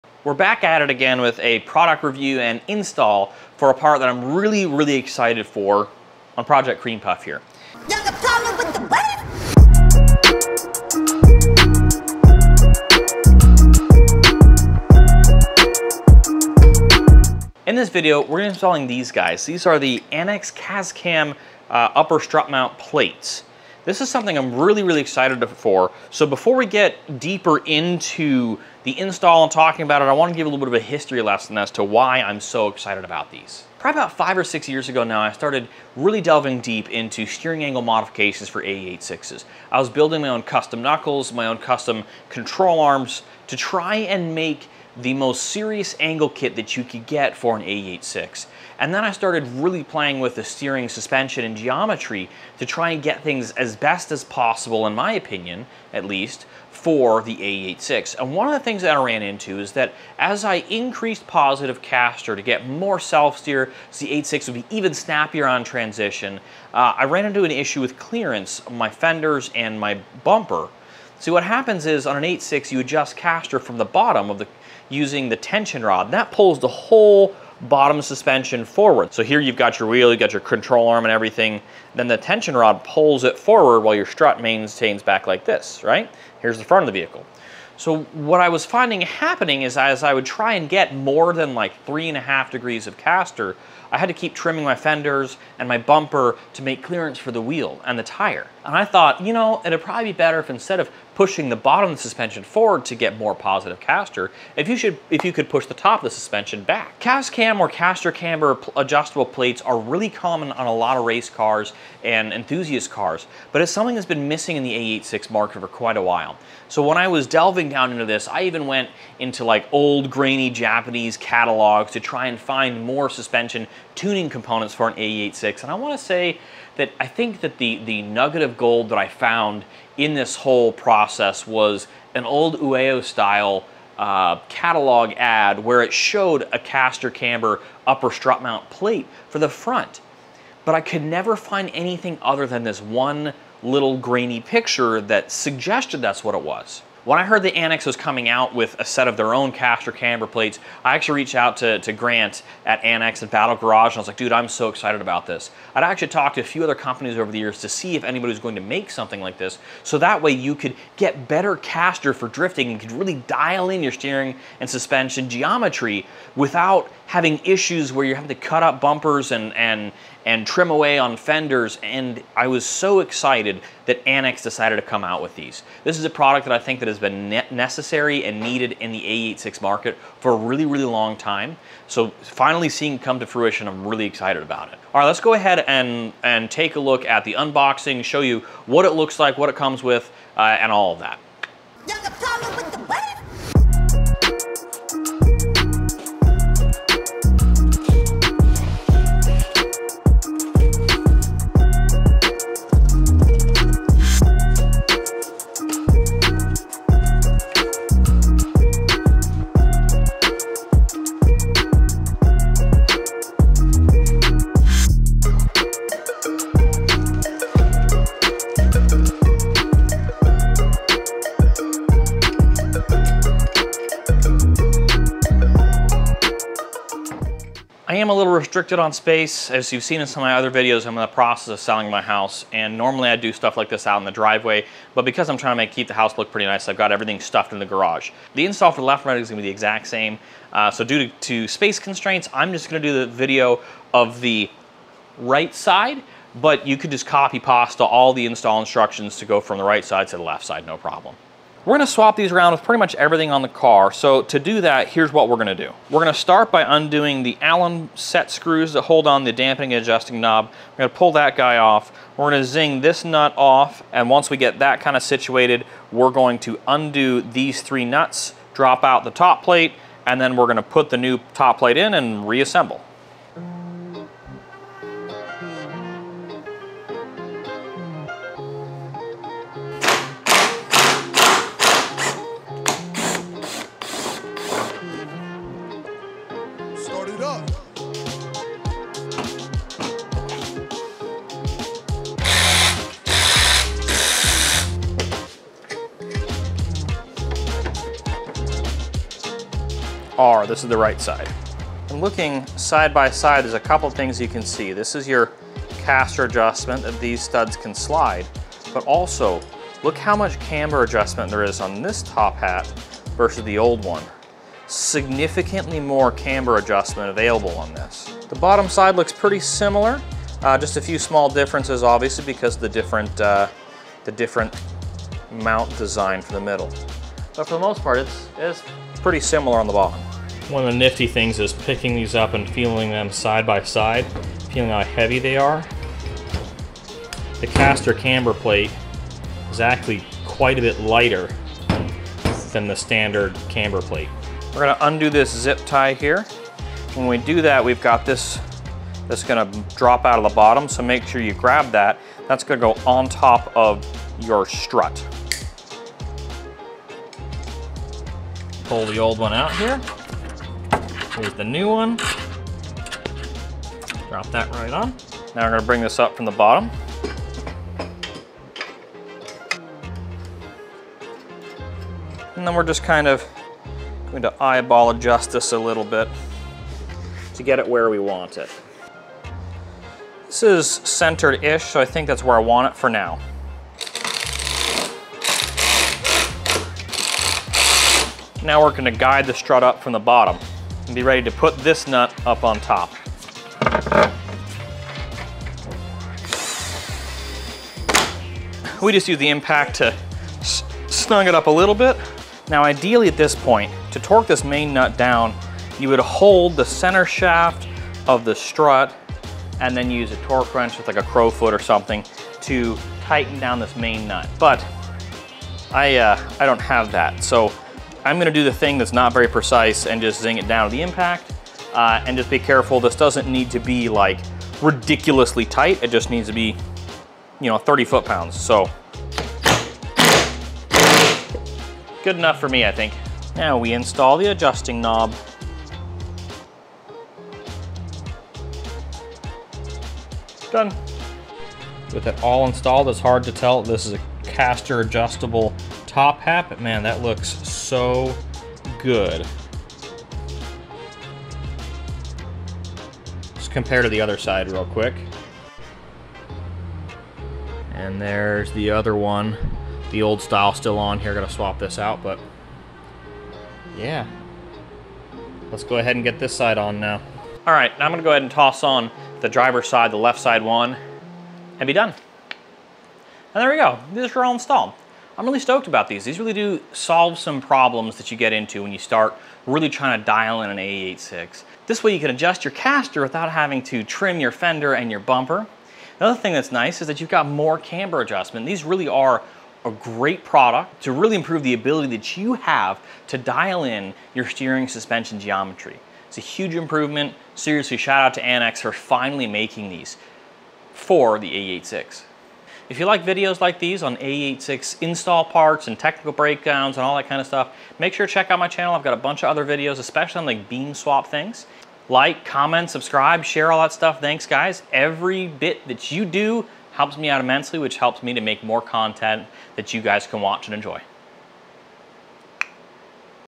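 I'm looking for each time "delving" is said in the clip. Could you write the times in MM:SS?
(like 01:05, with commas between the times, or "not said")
00:36, 01:57.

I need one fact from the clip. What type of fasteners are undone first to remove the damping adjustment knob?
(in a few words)
Allen set screws.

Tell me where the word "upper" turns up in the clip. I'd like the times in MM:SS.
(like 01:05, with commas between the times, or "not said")
00:21, 02:17.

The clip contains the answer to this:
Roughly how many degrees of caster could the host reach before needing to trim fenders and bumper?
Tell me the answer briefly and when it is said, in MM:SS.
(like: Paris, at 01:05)
3.5 degrees, at 01:31.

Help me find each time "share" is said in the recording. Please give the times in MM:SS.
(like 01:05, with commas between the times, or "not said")
08:33.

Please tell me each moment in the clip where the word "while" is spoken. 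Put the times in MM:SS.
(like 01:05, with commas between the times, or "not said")
01:23, 01:56.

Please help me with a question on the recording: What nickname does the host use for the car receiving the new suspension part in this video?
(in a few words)
Project Cream Puff.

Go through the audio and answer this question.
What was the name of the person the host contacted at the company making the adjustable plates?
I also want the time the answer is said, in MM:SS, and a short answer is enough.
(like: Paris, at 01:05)
Grant, at 02:31.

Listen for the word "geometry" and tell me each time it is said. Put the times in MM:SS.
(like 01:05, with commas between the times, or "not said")
00:51, 02:45, 08:15.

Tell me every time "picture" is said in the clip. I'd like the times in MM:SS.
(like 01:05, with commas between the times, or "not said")
02:24.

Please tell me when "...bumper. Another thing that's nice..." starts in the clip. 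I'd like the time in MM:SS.
08:05.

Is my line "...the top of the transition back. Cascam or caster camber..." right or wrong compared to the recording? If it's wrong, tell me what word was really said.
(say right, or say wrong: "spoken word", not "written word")
wrong: "suspension", not "transition".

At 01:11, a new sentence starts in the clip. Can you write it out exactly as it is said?
See what happens is on an 86 you adjust caster from the bottom of the using the tension rod.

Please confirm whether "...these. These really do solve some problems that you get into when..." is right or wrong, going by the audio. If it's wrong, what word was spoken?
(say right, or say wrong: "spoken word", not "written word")
right.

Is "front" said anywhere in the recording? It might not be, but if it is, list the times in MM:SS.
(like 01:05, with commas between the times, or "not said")
01:26, 02:19.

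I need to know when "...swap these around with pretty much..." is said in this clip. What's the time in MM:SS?
04:11.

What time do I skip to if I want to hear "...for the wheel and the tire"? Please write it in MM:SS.
01:37.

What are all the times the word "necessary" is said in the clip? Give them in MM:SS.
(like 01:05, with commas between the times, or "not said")
02:57.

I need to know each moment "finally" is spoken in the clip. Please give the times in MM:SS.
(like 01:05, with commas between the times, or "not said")
03:02, 08:18.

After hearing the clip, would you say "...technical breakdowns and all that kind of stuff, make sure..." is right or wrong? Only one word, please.
right.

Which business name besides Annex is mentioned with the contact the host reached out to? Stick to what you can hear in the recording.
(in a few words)
Battle Garage.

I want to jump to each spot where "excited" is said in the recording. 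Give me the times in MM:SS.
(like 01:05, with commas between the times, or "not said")
00:04, 00:25, 00:32, 02:34, 02:53, 03:04.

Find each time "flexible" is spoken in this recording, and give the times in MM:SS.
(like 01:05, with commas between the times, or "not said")
not said.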